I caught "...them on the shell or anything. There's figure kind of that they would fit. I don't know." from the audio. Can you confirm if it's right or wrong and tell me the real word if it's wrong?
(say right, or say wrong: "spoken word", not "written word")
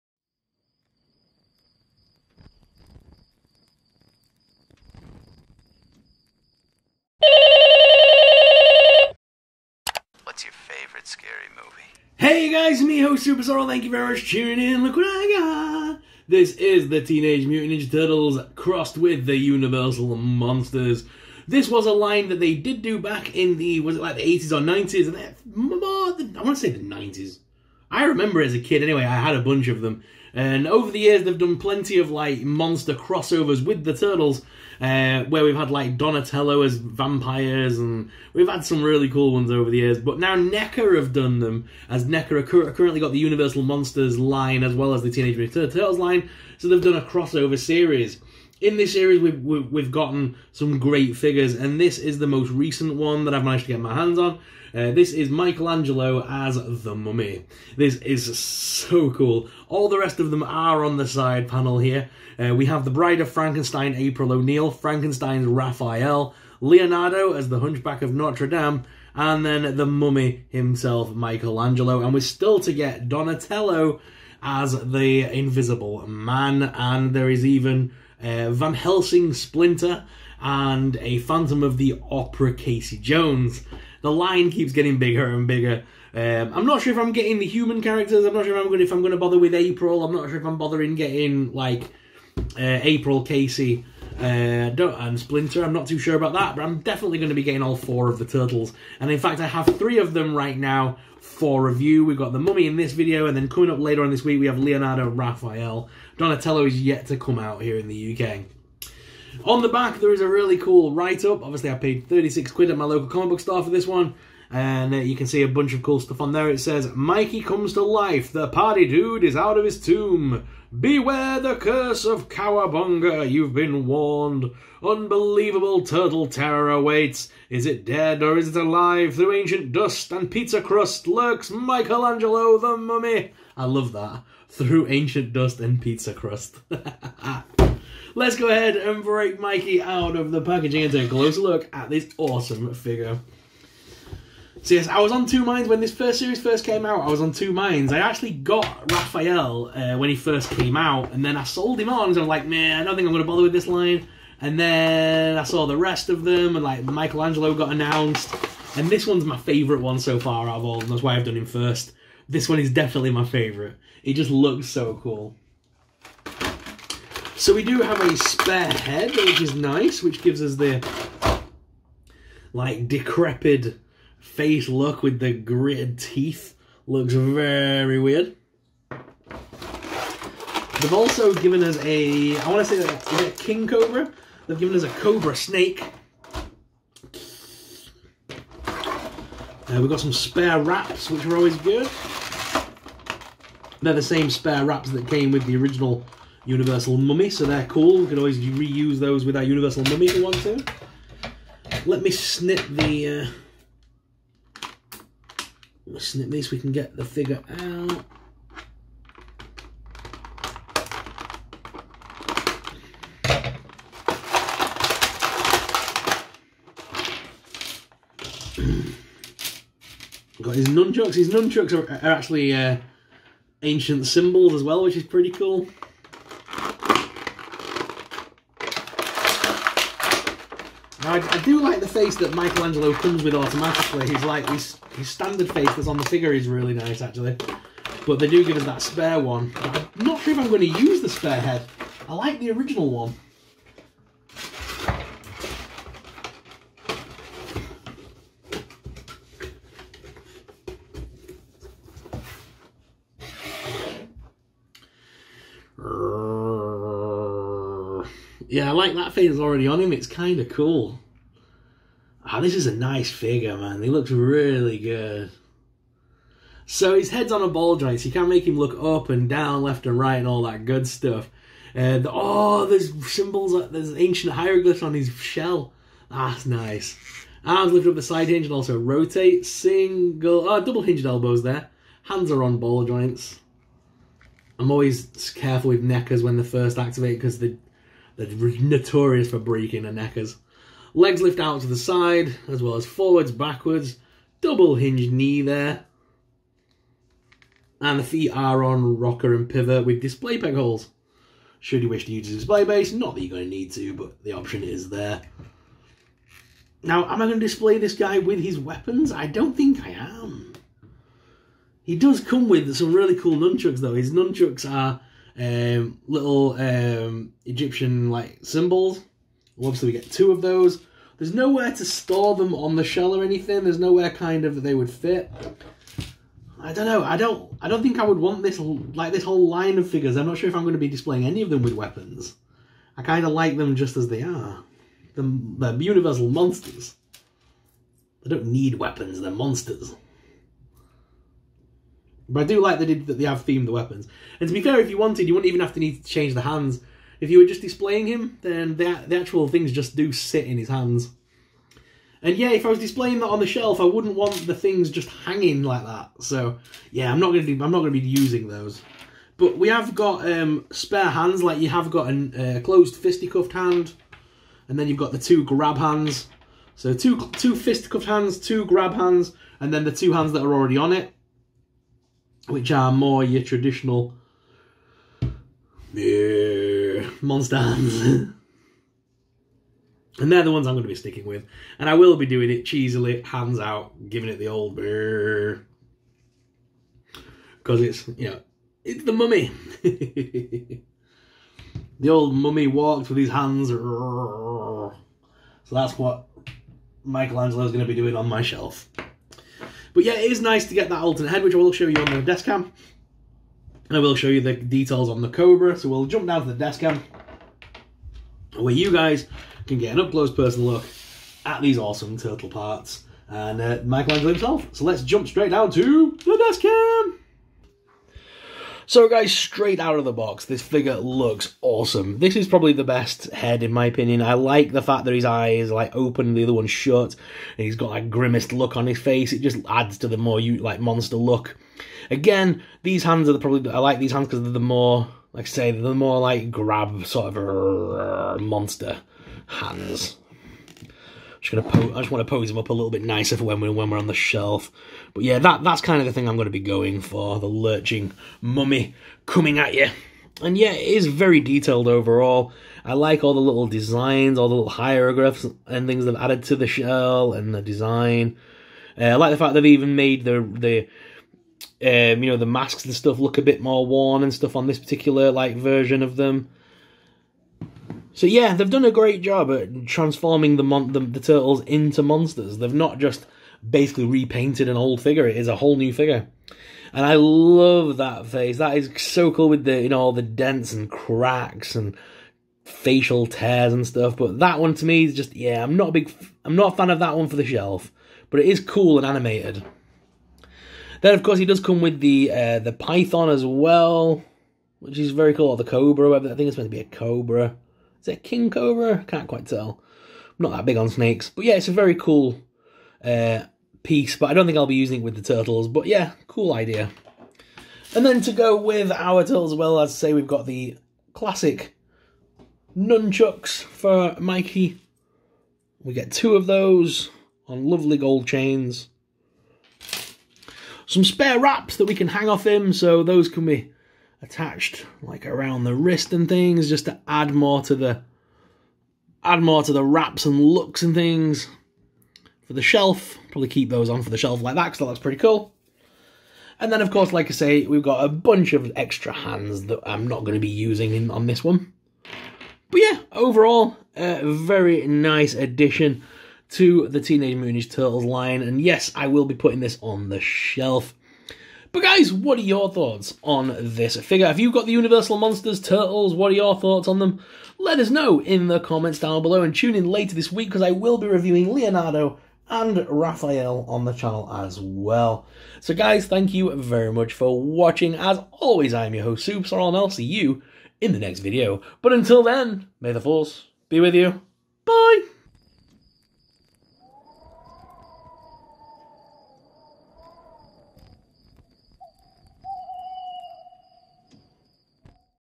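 wrong: "nowhere", not "figure".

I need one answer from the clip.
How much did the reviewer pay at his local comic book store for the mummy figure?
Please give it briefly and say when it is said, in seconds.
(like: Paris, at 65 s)
36 quid, at 112 s.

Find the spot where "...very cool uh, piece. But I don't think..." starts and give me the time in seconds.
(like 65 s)
501 s.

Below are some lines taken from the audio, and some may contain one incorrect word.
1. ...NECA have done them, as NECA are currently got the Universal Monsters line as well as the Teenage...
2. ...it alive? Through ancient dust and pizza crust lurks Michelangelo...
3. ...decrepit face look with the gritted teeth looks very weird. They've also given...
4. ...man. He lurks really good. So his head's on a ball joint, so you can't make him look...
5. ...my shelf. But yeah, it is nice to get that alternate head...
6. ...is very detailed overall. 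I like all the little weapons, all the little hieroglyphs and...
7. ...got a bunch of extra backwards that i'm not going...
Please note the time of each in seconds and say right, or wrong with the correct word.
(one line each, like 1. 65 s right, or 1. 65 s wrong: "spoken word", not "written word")
1. 40 s right
2. 128 s right
3. 172 s right
4. 263 s wrong: "looks", not "lurks"
5. 398 s right
6. 450 s wrong: "designs", not "weapons"
7. 537 s wrong: "hands", not "backwards".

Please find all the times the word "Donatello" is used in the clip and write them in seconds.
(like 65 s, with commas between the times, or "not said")
35 s, 73 s, 106 s.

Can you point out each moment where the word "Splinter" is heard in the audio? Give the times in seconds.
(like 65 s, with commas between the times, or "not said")
79 s, 95 s.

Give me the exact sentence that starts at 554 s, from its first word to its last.
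Have you got the Universal Monsters Turtles?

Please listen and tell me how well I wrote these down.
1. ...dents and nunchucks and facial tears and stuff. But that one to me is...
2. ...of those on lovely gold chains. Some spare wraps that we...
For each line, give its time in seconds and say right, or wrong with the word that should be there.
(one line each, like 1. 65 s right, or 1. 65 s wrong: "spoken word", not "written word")
1. 480 s wrong: "cracks", not "nunchucks"
2. 516 s right.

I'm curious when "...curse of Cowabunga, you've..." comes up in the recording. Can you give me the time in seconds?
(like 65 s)
121 s.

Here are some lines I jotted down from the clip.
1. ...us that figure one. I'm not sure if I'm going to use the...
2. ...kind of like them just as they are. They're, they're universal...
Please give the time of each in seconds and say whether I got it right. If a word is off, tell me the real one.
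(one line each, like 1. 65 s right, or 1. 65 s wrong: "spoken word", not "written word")
1. 238 s wrong: "spare", not "figure"
2. 333 s right.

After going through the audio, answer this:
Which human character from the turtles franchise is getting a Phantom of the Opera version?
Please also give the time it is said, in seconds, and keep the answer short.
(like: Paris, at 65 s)
Casey Jones, at 82 s.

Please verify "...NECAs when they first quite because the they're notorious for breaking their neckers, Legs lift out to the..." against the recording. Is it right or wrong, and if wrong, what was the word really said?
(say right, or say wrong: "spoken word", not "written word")
wrong: "activate", not "quite".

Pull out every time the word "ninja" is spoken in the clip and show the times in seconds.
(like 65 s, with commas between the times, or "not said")
17 s, 547 s.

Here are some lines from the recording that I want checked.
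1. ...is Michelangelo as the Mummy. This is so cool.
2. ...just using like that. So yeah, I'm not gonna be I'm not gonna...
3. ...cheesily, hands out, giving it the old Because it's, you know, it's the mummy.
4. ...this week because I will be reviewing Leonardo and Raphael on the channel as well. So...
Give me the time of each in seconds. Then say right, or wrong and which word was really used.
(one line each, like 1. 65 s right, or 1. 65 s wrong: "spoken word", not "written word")
1. 55 s right
2. 354 s wrong: "hanging", not "using"
3. 382 s right
4. 560 s right.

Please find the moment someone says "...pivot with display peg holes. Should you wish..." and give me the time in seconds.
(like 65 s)
299 s.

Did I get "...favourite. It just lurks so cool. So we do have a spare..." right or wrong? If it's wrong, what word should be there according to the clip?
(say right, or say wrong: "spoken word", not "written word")
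wrong: "looks", not "lurks".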